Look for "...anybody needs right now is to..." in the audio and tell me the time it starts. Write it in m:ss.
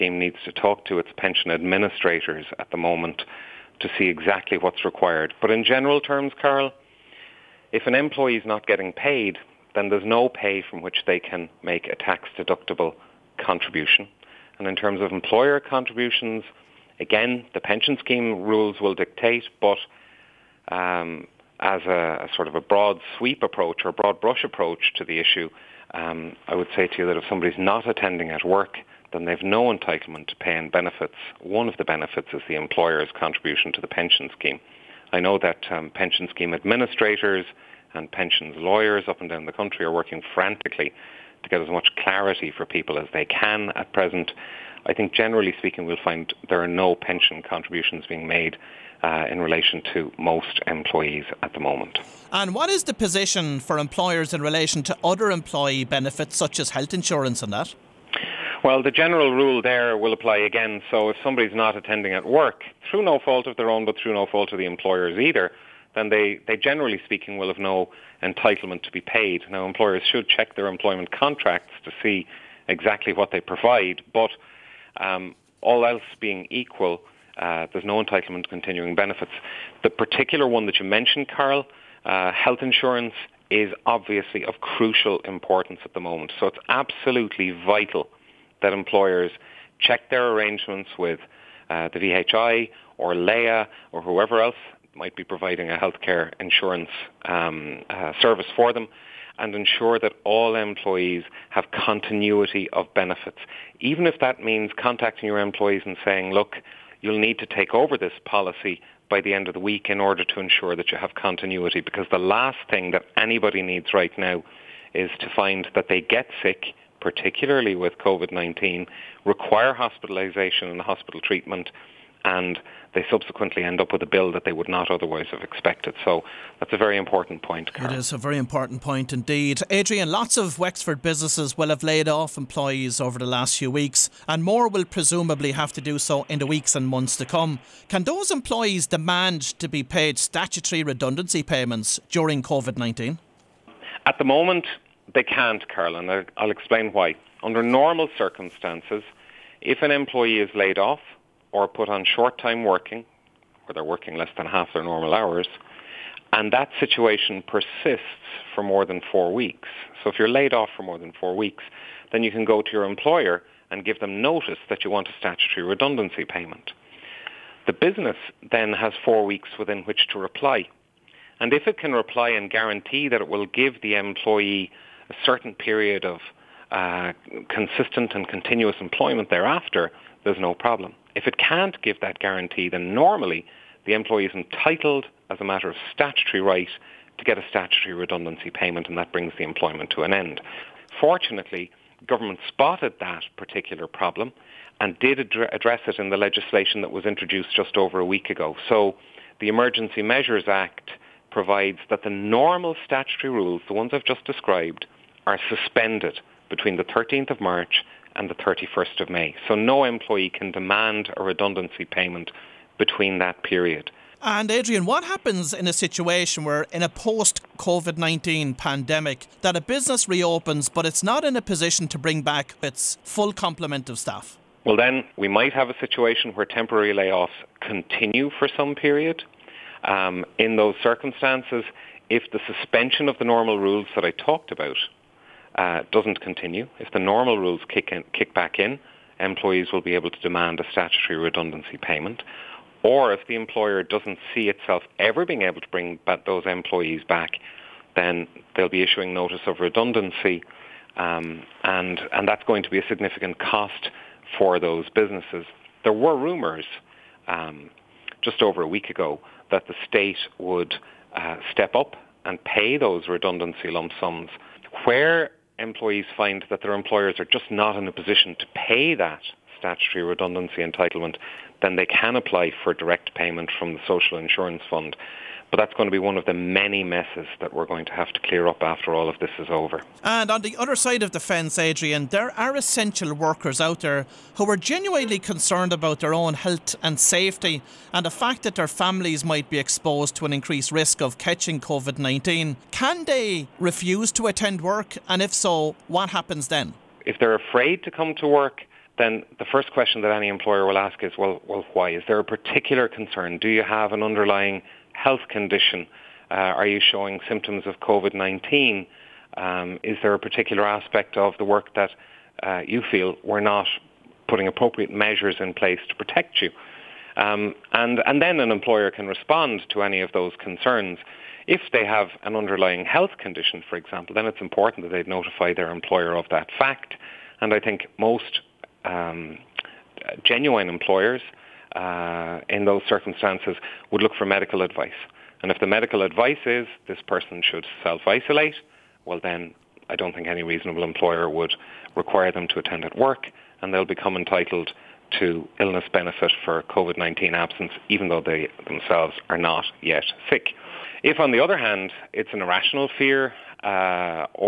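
1:53.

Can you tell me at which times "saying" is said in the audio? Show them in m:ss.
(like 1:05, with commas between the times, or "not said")
1:46.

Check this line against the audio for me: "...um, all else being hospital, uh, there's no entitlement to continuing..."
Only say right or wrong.
wrong.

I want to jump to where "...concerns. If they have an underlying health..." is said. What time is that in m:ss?
5:20.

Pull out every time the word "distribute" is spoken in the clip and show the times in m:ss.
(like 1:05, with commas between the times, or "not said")
not said.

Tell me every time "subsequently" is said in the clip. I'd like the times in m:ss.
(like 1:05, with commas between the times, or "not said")
2:03.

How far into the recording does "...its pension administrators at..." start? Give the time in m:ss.
0:00.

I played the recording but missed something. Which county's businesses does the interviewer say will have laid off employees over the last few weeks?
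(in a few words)
Wexford.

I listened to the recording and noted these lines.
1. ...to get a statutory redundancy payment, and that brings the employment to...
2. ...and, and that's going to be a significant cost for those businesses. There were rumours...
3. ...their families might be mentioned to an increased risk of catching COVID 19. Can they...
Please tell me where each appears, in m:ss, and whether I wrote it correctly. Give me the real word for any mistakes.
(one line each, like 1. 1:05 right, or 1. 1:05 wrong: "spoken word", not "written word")
1. 3:07 right
2. 4:11 right
3. 4:48 wrong: "exposed", not "mentioned".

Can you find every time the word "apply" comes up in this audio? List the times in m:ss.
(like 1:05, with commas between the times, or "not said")
1:00, 4:32.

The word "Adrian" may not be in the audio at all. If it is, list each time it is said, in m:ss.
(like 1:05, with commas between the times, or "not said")
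2:09, 3:34, 4:41.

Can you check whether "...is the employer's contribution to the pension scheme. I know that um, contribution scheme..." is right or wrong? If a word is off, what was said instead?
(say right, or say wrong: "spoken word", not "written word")
wrong: "pension", not "contribution".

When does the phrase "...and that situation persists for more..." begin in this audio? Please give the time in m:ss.
2:36.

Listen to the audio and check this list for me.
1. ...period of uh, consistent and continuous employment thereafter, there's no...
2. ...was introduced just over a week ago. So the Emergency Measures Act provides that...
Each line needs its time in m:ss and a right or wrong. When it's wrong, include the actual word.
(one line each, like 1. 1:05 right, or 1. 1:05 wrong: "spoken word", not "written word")
1. 2:55 right
2. 3:16 right.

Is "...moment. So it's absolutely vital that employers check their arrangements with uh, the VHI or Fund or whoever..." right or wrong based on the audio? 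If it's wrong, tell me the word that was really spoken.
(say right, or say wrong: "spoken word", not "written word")
wrong: "Laya", not "Fund".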